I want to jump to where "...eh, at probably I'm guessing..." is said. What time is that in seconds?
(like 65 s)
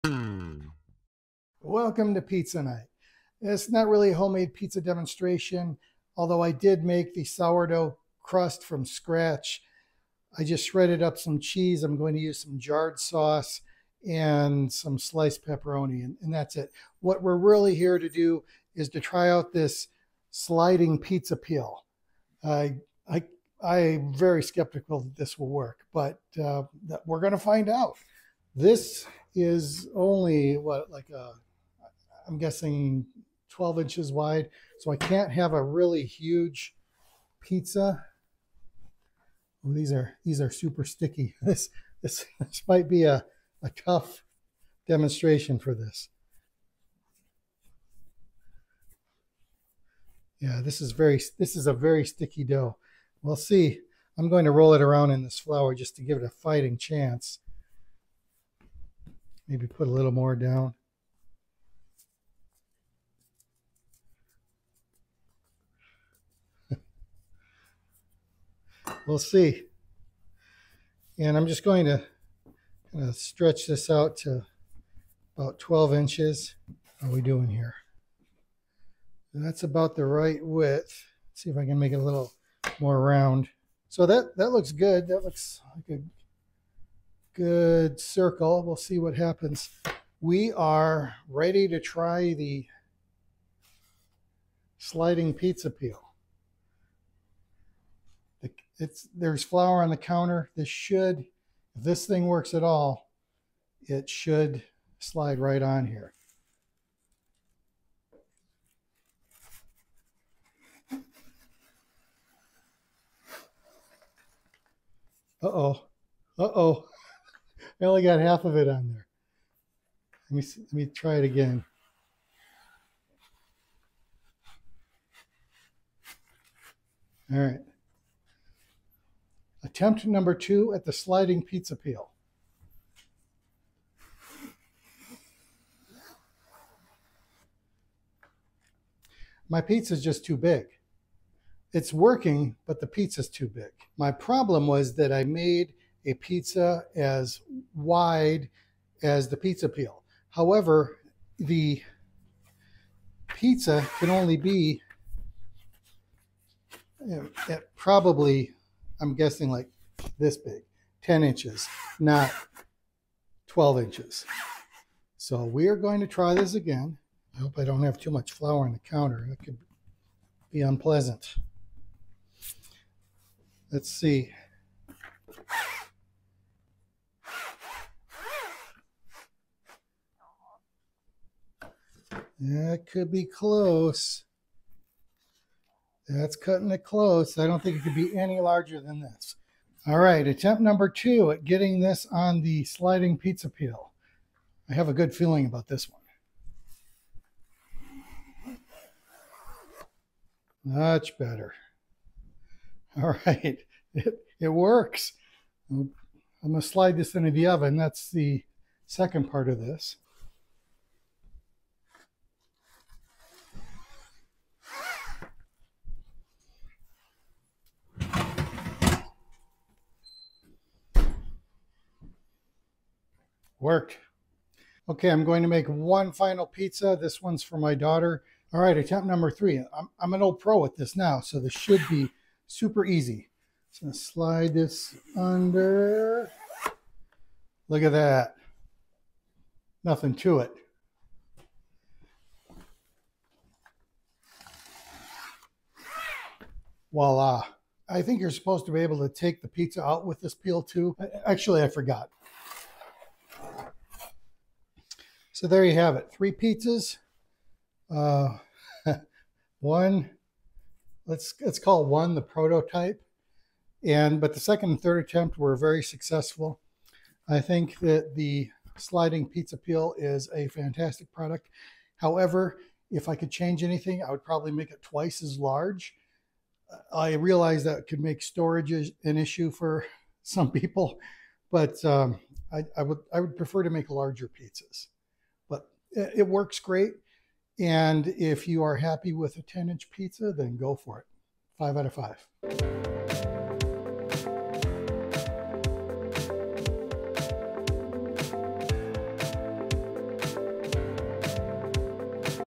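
157 s.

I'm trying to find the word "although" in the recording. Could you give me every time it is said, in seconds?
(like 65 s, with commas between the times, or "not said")
6 s.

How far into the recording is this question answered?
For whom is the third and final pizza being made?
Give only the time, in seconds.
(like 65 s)
227 s.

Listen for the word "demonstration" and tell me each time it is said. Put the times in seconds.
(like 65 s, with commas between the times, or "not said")
4 s, 44 s.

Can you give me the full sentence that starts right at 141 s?
It's working, but the pizza's too big.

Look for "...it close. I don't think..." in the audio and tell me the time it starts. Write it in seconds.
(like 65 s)
186 s.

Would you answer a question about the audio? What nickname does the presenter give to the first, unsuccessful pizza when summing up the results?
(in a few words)
the prototype.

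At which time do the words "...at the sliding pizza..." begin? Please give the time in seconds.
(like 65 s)
130 s.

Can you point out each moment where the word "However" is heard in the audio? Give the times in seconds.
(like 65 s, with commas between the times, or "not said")
150 s, 271 s.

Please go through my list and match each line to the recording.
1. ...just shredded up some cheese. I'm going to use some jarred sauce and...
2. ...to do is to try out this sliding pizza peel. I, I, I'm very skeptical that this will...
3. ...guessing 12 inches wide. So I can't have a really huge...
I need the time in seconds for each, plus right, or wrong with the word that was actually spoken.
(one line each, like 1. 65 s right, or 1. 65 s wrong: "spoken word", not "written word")
1. 10 s right
2. 17 s right
3. 32 s right.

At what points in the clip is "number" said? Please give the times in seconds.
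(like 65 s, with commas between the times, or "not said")
130 s, 190 s, 229 s.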